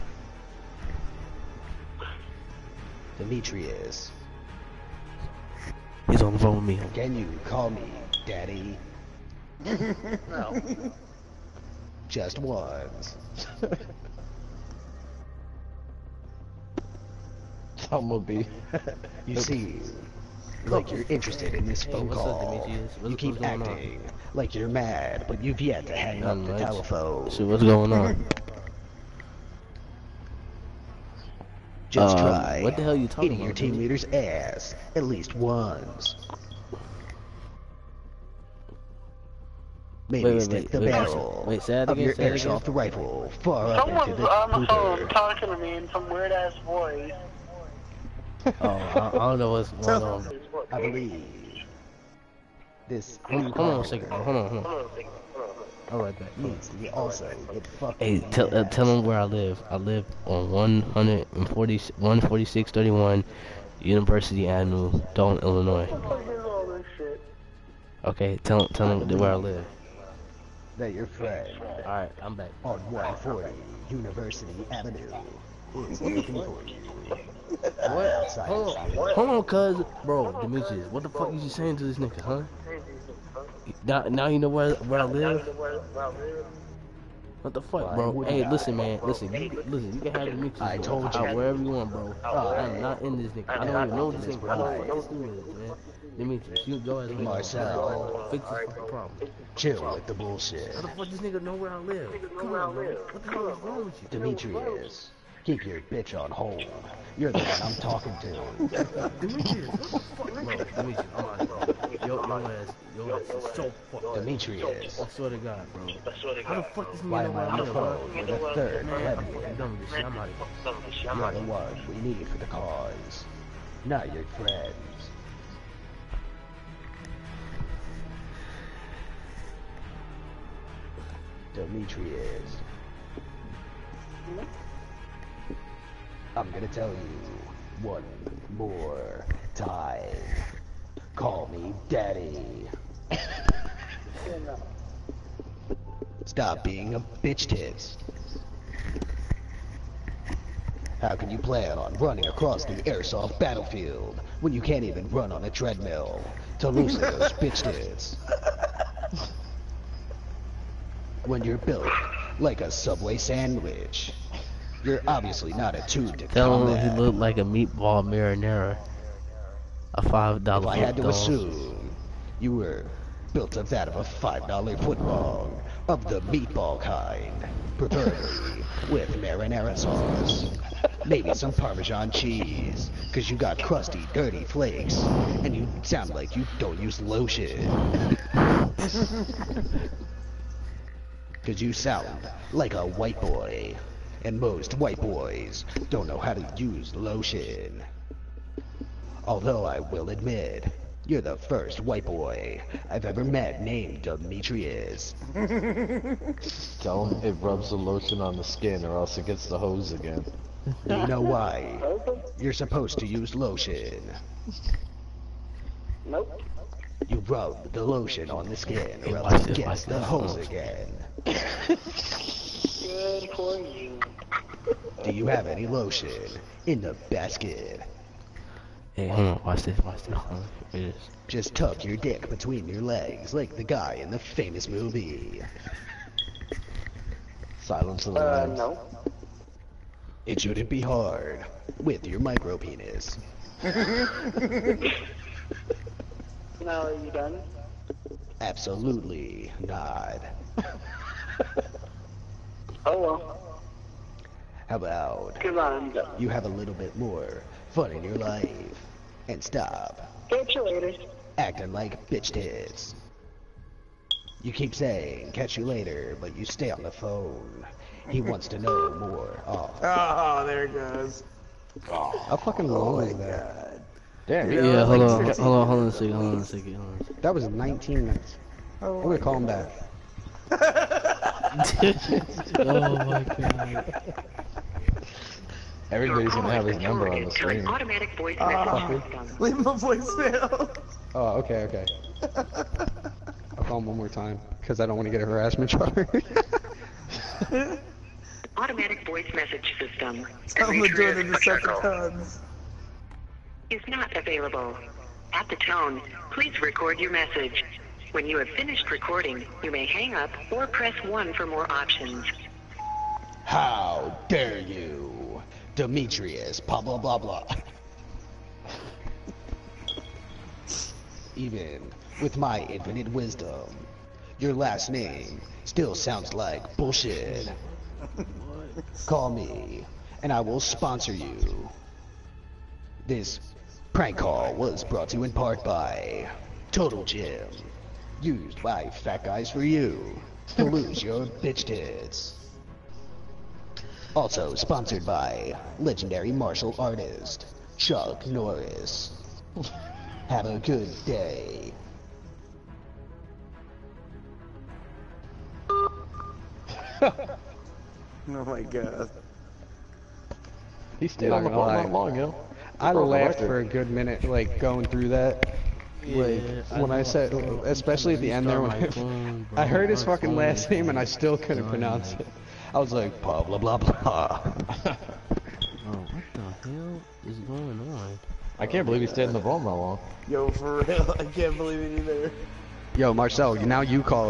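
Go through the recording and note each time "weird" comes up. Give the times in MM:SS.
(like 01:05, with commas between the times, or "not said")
00:46.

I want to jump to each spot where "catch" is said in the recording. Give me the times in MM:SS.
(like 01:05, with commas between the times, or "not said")
04:20, 04:25.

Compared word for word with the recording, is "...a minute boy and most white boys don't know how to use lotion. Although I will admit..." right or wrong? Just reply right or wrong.
wrong.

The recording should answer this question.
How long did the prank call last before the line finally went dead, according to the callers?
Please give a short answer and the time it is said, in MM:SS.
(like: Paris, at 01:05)
19 minutes, at 04:37.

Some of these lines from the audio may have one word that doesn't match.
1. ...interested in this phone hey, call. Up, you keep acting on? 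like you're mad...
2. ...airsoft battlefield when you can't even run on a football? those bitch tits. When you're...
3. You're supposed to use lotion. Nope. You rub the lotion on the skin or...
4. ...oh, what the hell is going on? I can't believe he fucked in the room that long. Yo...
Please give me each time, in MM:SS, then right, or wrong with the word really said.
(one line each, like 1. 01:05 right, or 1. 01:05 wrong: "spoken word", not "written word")
1. 00:21 right
2. 02:32 wrong: "treadmill", not "football"
3. 03:32 right
4. 06:14 wrong: "stayed", not "fucked".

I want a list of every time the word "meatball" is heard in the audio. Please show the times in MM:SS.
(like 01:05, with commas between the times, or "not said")
02:47, 02:56.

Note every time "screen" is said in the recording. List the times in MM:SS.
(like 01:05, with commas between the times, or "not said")
04:47.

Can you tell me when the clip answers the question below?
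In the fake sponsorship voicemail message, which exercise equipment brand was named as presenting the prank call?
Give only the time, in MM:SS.
05:36.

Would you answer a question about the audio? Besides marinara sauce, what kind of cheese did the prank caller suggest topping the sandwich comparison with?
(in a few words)
Parmesan.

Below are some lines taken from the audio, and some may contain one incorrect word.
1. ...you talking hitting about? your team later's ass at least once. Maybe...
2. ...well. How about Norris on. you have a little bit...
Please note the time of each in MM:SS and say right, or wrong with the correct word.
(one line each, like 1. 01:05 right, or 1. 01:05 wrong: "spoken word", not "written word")
1. 00:32 wrong: "leader", not "later"
2. 04:12 wrong: "Come", not "Norris".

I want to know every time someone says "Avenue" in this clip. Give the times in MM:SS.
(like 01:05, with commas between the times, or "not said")
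01:04, 01:14.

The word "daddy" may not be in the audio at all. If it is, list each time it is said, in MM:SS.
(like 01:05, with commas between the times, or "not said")
00:08, 02:21.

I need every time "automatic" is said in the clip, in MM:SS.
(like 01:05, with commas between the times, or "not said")
04:47, 04:58.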